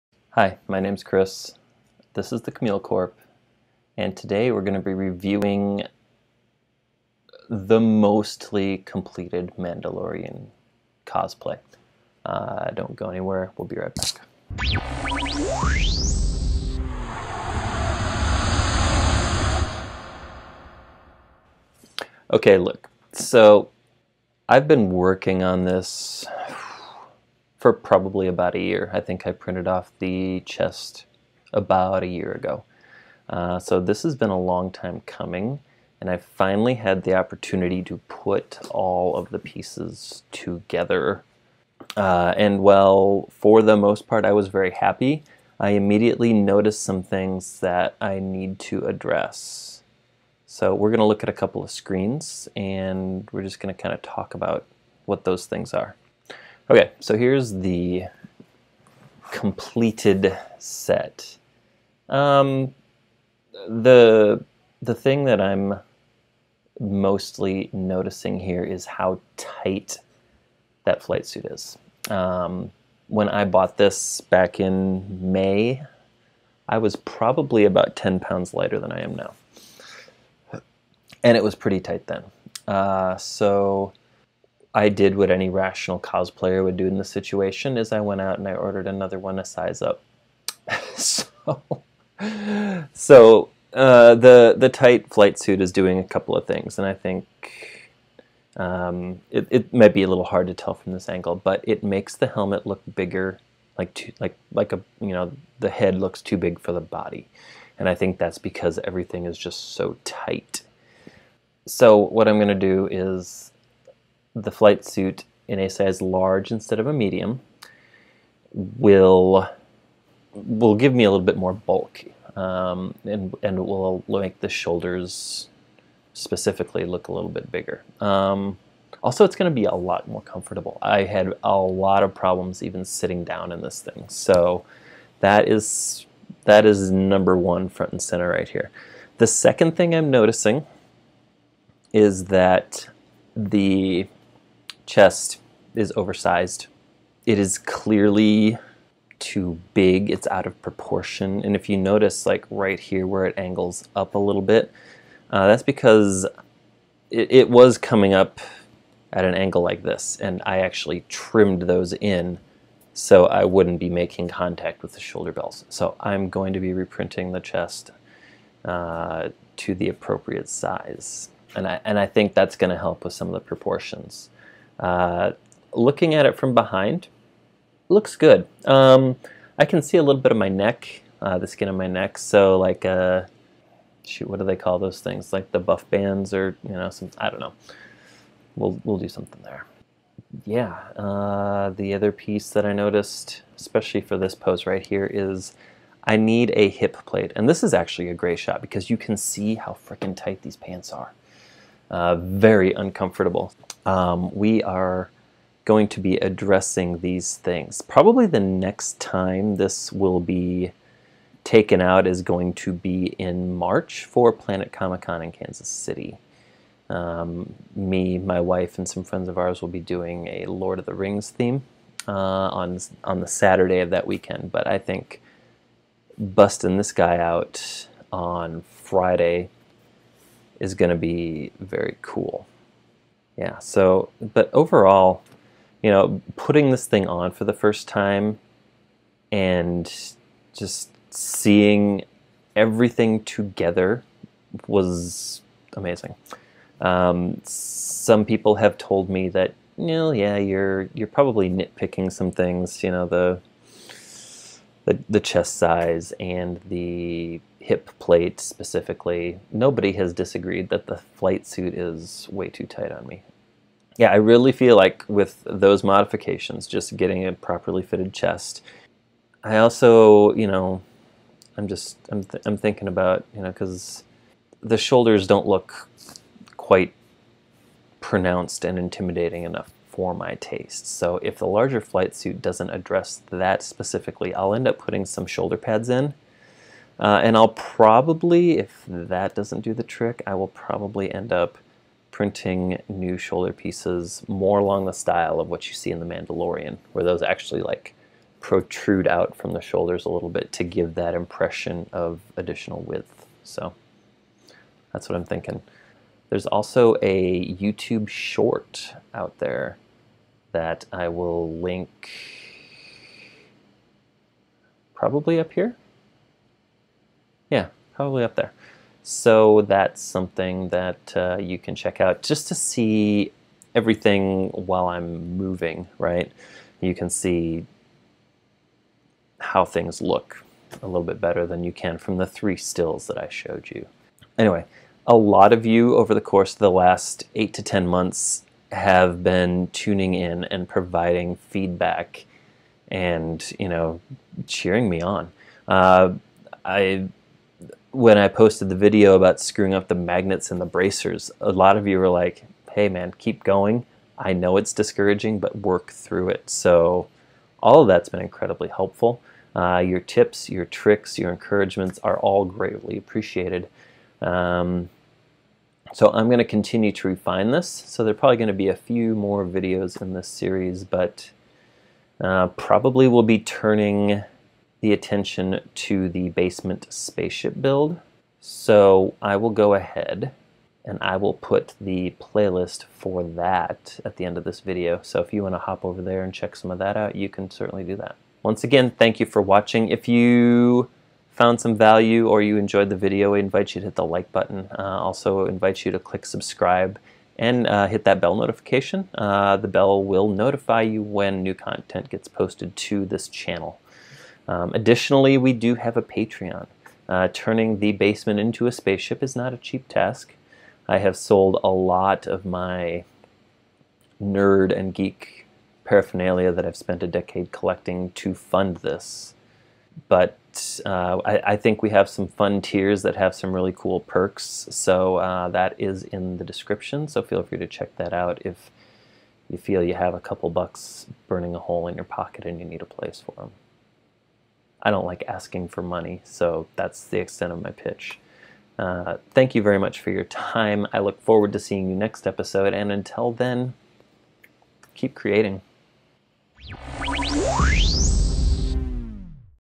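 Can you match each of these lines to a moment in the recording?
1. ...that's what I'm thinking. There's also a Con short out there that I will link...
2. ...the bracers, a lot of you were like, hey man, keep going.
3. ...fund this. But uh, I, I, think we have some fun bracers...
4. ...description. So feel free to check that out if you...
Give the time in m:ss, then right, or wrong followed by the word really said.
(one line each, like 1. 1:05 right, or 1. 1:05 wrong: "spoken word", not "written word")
1. 5:04 wrong: "YouTube", not "Con"
2. 5:50 right
3. 6:58 wrong: "tiers", not "bracers"
4. 7:06 right.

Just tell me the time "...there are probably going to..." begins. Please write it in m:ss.
6:08.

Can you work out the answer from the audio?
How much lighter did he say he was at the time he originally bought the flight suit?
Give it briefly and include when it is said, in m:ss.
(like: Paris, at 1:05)
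10 pounds, at 1:17.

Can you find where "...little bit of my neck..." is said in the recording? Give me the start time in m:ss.
3:00.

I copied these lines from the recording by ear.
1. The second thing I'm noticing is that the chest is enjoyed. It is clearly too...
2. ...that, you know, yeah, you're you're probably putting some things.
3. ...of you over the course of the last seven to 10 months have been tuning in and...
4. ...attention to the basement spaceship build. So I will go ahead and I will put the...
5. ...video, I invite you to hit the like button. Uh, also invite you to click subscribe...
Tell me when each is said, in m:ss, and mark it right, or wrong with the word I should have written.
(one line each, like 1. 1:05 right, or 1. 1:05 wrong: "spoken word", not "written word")
1. 2:19 wrong: "oversized", not "enjoyed"
2. 4:09 wrong: "nitpicking", not "putting"
3. 5:35 wrong: "eight", not "seven"
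4. 6:14 right
5. 6:32 right.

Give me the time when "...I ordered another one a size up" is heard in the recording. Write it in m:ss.
1:28.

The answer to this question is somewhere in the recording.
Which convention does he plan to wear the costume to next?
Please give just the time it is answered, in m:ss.
3:34.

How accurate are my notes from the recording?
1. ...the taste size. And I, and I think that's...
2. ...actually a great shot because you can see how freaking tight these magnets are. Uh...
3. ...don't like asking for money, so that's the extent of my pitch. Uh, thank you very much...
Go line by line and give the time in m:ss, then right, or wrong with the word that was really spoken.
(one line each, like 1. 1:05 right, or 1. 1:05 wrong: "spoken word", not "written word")
1. 2:49 wrong: "appropriate", not "taste"
2. 3:17 wrong: "pants", not "magnets"
3. 7:14 right.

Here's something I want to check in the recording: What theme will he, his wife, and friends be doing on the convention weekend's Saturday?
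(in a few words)
Lord of the Rings.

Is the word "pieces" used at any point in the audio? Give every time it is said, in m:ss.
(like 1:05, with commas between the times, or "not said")
0:39, 3:12, 4:53.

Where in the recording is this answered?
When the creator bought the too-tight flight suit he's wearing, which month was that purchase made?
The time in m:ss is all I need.
1:15.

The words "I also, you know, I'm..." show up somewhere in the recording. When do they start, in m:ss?
4:29.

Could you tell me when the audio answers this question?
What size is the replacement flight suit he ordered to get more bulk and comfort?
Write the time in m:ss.
1:56.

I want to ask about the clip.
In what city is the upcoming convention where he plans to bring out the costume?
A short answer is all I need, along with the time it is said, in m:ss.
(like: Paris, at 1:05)
Kansas City, at 3:35.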